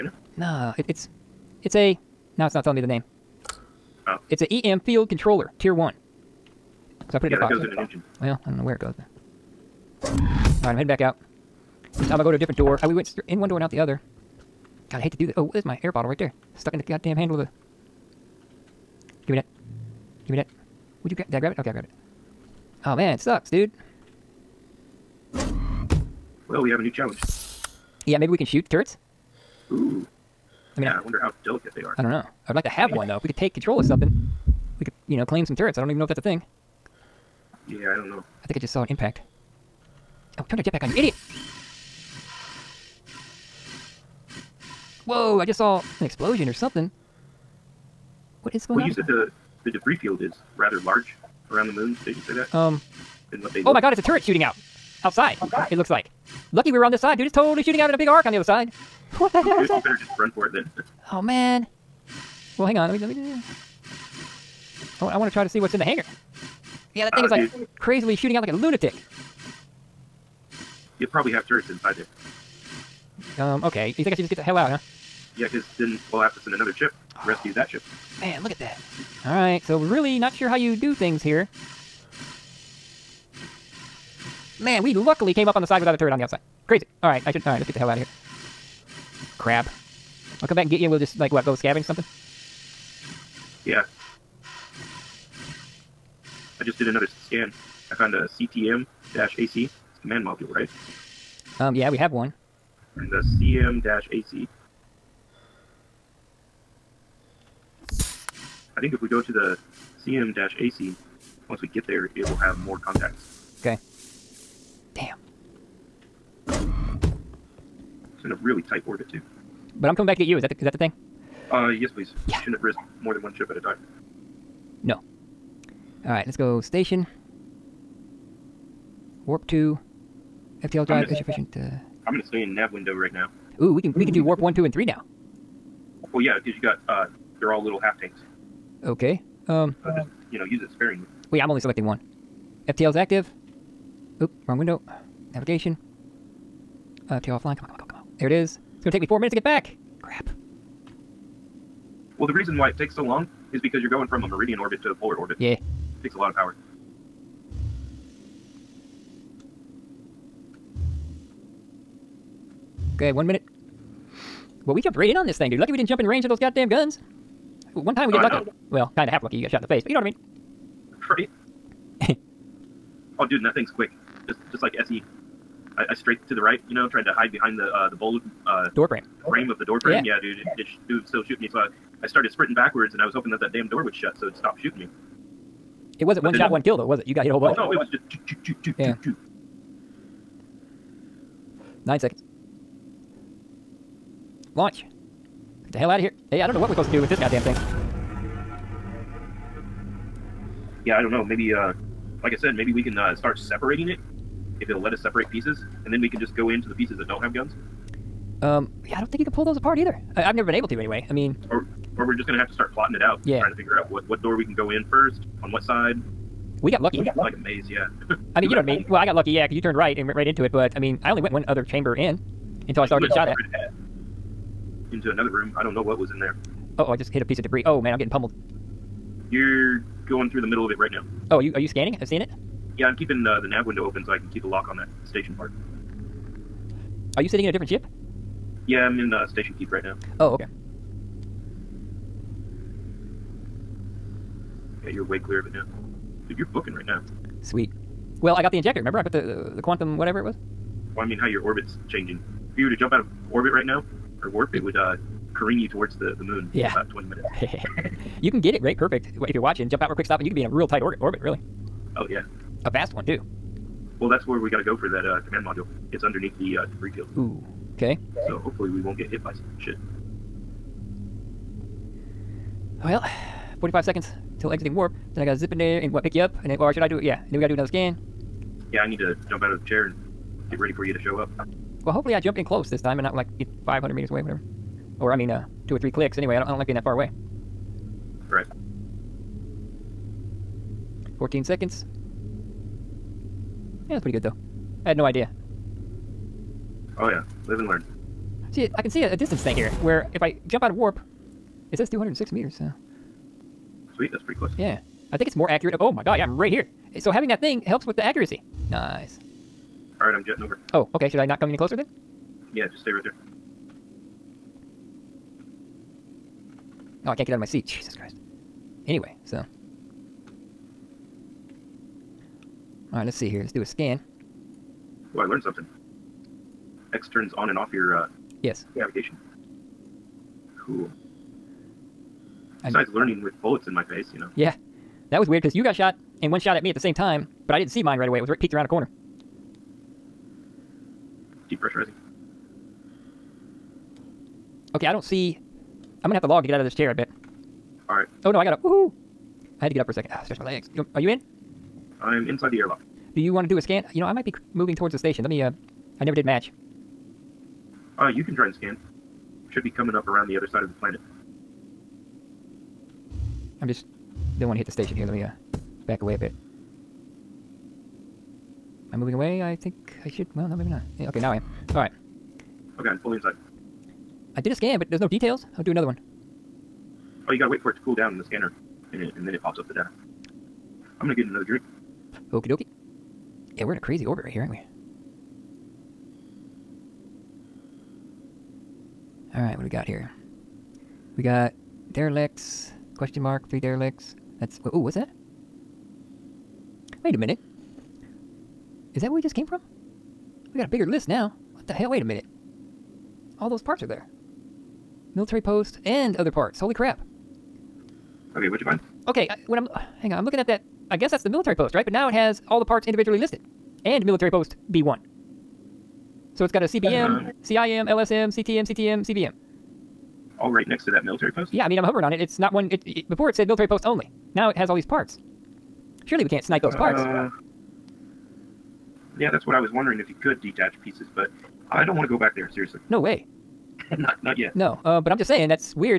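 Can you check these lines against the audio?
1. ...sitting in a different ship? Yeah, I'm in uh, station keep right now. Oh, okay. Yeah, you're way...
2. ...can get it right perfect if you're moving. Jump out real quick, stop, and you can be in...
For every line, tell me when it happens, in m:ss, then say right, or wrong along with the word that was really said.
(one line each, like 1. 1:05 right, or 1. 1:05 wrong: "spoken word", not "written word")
1. 3:57 right
2. 4:18 wrong: "watching", not "moving".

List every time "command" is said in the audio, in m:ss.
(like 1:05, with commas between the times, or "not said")
1:40, 4:25.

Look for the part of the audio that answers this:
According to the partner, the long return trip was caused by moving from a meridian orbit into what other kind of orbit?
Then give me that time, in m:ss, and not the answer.
2:34.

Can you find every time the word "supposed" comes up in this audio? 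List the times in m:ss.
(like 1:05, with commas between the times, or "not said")
3:16.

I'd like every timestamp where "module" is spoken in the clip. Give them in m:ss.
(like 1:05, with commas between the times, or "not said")
1:40, 4:25.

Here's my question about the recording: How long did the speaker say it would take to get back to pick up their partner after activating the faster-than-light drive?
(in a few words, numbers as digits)
4 minutes.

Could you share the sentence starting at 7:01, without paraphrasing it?
Yeah, I mean, I'm hovering on it.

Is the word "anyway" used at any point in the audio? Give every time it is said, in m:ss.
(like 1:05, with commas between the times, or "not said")
3:30, 4:46, 5:18.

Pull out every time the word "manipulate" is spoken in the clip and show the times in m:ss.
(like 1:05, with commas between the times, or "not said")
not said.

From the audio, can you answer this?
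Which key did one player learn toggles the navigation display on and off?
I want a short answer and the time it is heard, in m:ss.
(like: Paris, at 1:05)
X, at 5:26.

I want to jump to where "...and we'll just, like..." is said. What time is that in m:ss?
1:30.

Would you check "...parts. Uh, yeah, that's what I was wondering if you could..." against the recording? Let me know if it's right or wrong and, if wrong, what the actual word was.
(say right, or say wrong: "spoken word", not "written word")
right.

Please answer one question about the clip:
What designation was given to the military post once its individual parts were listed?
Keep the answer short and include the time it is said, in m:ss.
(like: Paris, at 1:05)
military post B1, at 6:54.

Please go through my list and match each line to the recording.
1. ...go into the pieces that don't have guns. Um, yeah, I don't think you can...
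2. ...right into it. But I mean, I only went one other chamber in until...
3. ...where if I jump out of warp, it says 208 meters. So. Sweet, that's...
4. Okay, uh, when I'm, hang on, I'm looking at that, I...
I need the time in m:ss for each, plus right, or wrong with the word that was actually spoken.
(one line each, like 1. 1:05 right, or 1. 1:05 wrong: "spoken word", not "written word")
1. 3:26 right
2. 3:40 right
3. 4:59 wrong: "206", not "208"
4. 6:49 right.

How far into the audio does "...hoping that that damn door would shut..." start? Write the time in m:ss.
3:03.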